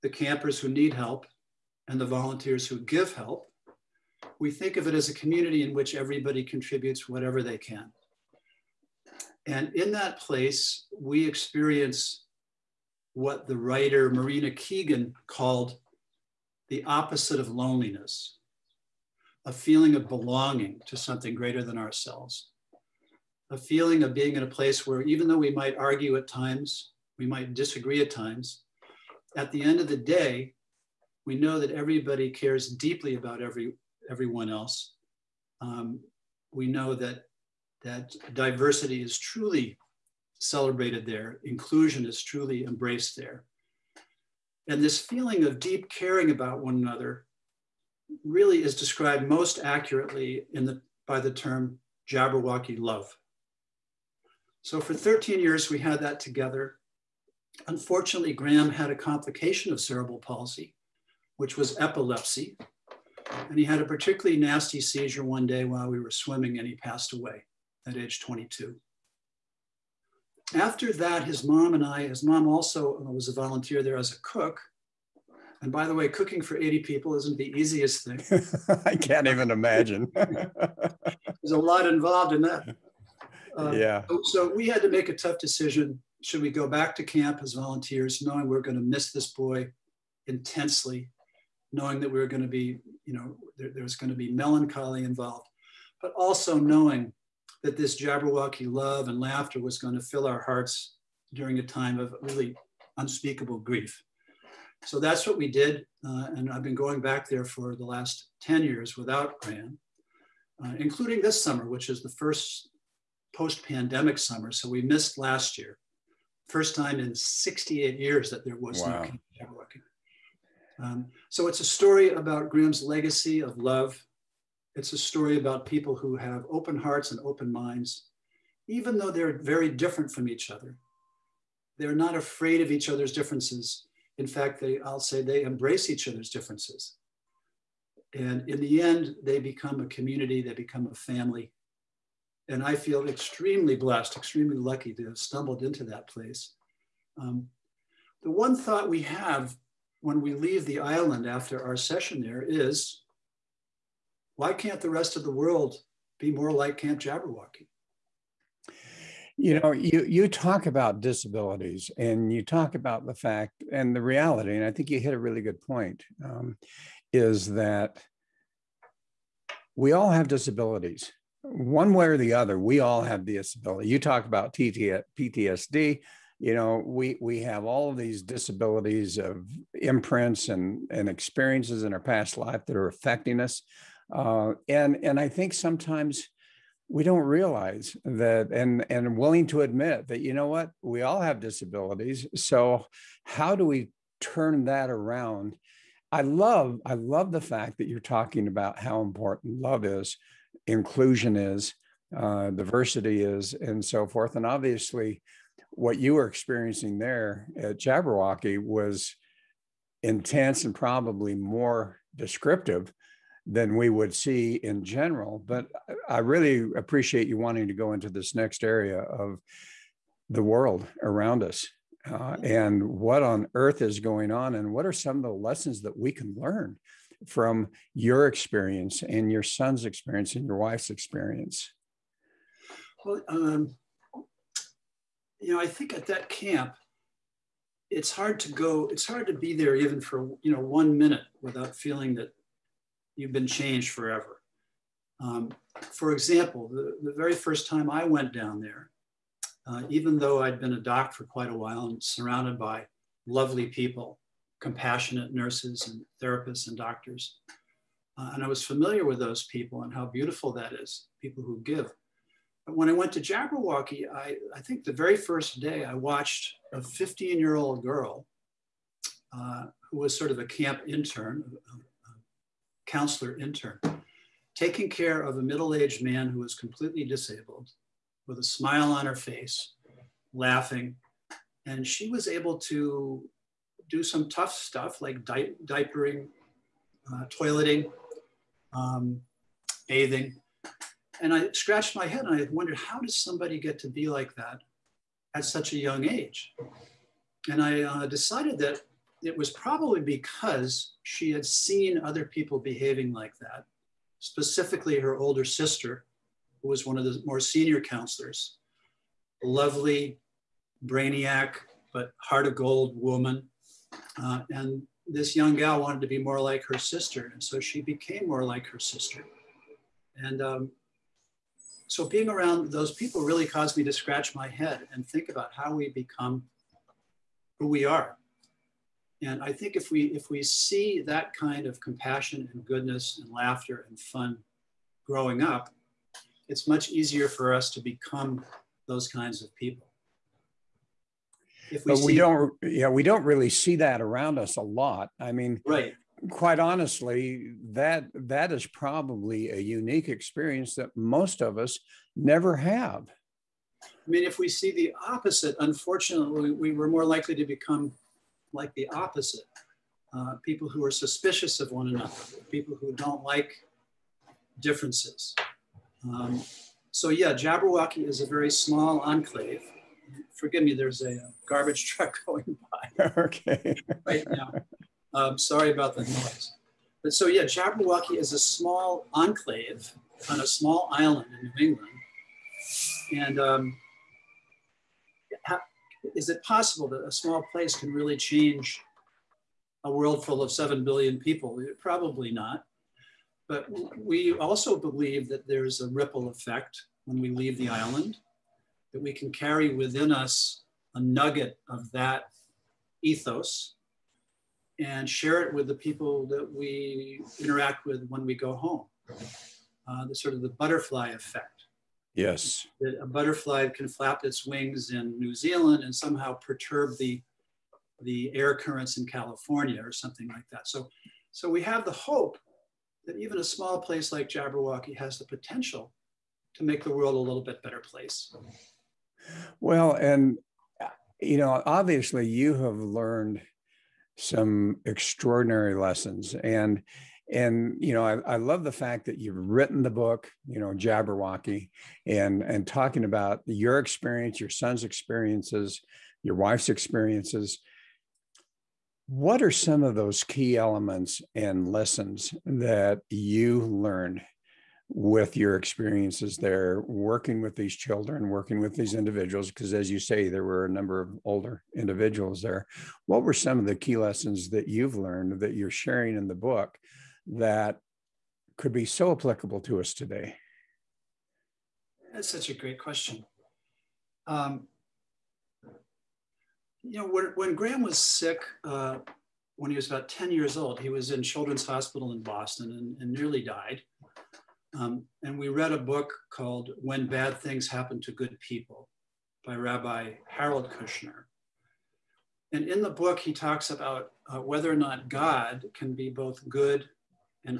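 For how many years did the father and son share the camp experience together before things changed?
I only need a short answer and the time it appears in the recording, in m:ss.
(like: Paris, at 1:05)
13, at 0:54.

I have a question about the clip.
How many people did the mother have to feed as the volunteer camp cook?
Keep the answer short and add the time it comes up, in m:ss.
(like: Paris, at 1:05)
80, at 1:16.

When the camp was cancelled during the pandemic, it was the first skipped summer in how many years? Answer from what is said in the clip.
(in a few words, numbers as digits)
68.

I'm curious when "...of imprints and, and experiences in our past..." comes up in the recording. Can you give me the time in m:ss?
2:59.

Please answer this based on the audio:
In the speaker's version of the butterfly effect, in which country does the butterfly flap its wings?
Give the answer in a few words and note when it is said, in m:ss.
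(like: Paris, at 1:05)
New Zealand, at 6:55.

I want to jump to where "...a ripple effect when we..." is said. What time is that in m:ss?
6:35.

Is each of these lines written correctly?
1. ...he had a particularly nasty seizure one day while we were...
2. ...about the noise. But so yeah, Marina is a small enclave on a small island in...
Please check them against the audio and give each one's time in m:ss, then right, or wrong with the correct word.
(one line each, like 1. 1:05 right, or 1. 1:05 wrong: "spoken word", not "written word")
1. 1:03 right
2. 6:15 wrong: "Jabberwocky", not "Marina".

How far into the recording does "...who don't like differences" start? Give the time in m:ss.
6:02.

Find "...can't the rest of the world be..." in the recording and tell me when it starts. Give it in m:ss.
2:34.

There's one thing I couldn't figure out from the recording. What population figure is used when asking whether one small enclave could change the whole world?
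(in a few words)
7 billion.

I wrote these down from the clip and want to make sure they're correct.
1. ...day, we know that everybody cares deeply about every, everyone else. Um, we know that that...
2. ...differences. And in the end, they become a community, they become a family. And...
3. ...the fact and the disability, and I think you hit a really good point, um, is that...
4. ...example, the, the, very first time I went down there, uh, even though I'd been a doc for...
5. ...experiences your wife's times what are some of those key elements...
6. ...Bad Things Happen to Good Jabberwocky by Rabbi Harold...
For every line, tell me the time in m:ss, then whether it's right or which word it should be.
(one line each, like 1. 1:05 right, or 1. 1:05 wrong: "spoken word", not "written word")
1. 0:29 right
2. 2:16 right
3. 2:43 wrong: "reality", not "disability"
4. 4:06 right
5. 7:24 wrong: "experiences", not "times"
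6. 8:07 wrong: "People", not "Jabberwocky".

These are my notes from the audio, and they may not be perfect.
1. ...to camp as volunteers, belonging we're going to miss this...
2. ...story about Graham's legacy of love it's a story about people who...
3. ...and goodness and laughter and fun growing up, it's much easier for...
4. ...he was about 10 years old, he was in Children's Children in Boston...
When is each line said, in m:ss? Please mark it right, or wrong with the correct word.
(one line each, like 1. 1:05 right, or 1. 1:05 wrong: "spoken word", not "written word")
1. 1:26 wrong: "knowing", not "belonging"
2. 2:01 right
3. 5:32 right
4. 7:59 wrong: "Hospital", not "Children".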